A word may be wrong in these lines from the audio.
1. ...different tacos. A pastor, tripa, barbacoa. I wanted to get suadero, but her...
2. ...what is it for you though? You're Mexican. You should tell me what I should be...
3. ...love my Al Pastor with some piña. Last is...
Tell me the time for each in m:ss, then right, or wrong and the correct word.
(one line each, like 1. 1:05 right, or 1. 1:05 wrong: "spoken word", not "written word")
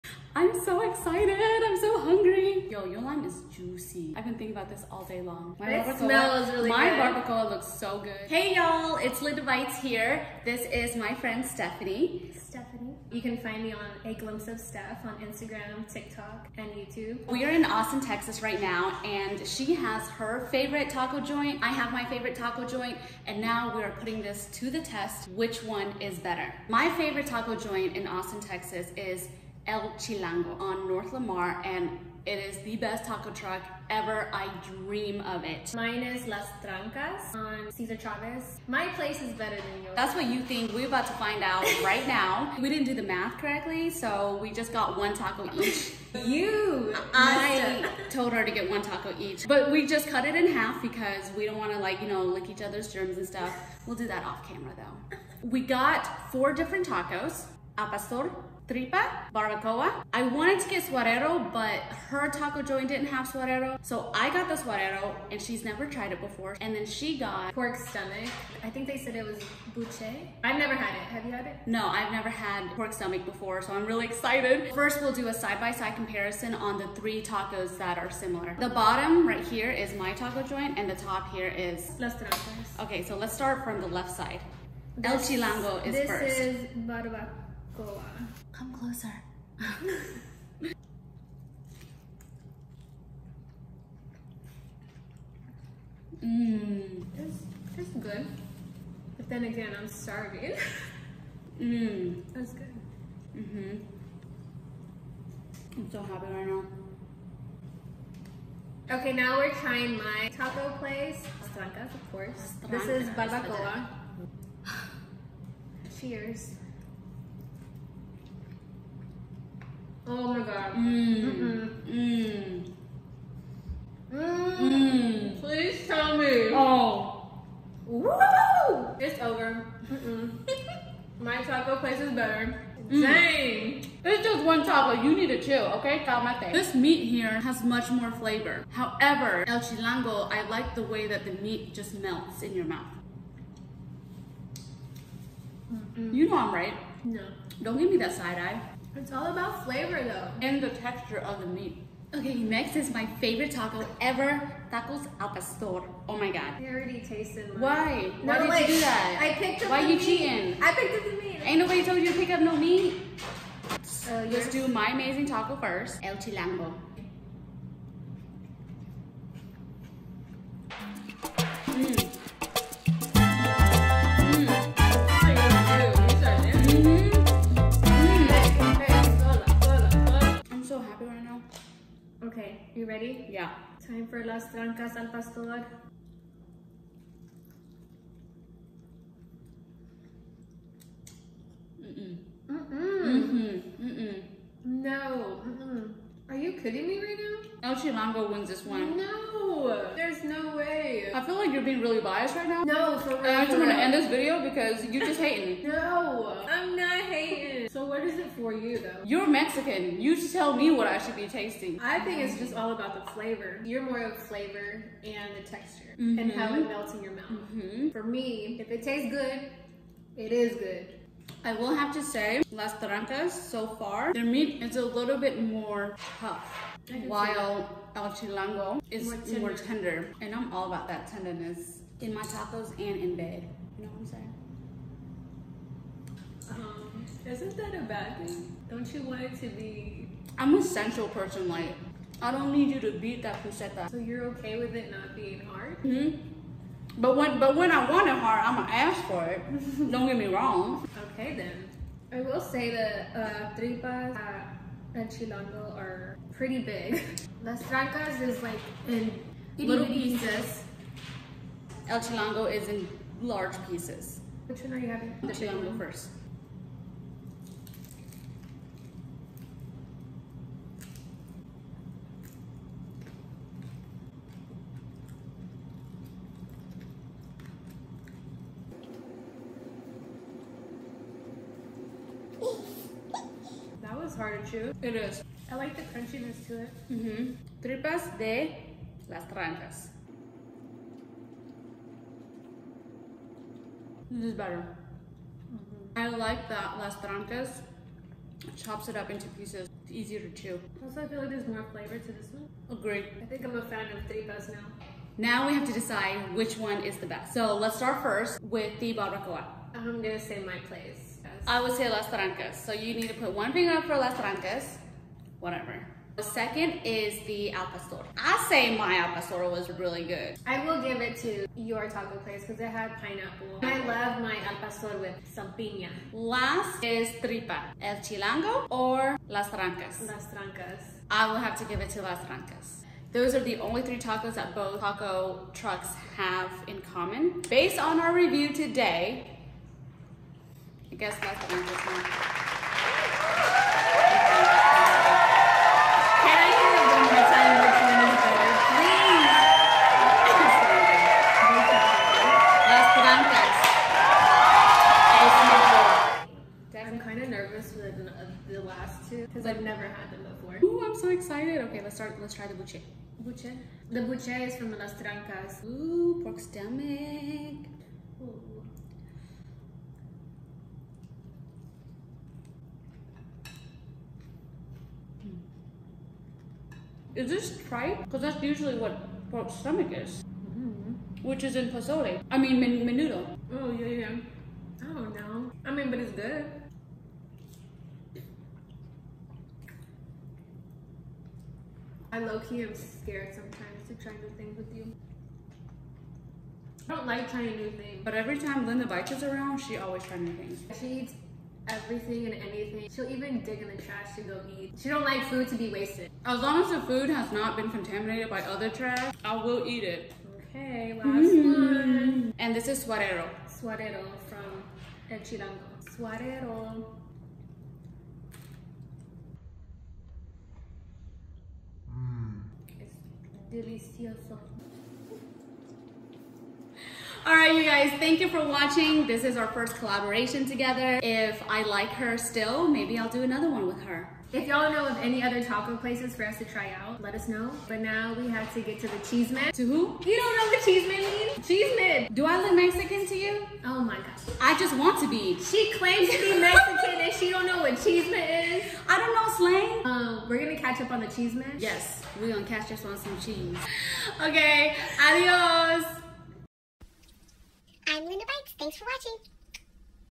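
1. 0:56 right
2. 3:27 right
3. 5:23 right.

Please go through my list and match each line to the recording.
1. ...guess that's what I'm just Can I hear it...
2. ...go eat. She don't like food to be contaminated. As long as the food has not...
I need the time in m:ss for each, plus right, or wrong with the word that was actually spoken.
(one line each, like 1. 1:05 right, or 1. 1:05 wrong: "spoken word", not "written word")
1. 5:40 right
2. 6:44 wrong: "wasted", not "contaminated".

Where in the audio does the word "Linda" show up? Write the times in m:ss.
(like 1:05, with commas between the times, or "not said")
0:09, 6:38, 7:38.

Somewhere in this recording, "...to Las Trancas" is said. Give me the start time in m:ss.
5:31.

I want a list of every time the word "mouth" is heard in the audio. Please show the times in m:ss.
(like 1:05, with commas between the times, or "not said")
2:22, 3:37.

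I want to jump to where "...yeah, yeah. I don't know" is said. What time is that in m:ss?
6:23.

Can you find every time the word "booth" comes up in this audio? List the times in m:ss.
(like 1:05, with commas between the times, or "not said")
not said.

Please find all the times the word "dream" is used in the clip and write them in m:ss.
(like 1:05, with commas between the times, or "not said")
0:34.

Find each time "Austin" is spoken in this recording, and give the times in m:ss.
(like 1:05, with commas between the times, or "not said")
0:17, 0:28.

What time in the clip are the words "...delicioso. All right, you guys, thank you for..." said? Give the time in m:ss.
7:03.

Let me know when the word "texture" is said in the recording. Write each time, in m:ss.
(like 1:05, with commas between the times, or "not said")
2:30, 3:35.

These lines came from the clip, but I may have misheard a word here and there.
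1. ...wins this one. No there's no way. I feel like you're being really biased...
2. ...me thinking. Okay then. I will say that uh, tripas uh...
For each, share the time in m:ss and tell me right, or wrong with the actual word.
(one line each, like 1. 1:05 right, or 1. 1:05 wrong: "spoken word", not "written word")
1. 3:18 right
2. 4:10 wrong: "wrong", not "thinking".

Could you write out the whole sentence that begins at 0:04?
I've been thinking about this all day long.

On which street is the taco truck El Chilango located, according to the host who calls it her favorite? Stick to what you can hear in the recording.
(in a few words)
North Lamar.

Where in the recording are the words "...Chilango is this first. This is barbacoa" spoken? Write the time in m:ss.
1:25.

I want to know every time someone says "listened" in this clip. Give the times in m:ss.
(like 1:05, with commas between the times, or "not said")
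not said.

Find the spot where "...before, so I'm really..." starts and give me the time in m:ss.
1:13.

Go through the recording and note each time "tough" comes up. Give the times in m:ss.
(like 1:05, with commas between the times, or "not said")
3:46.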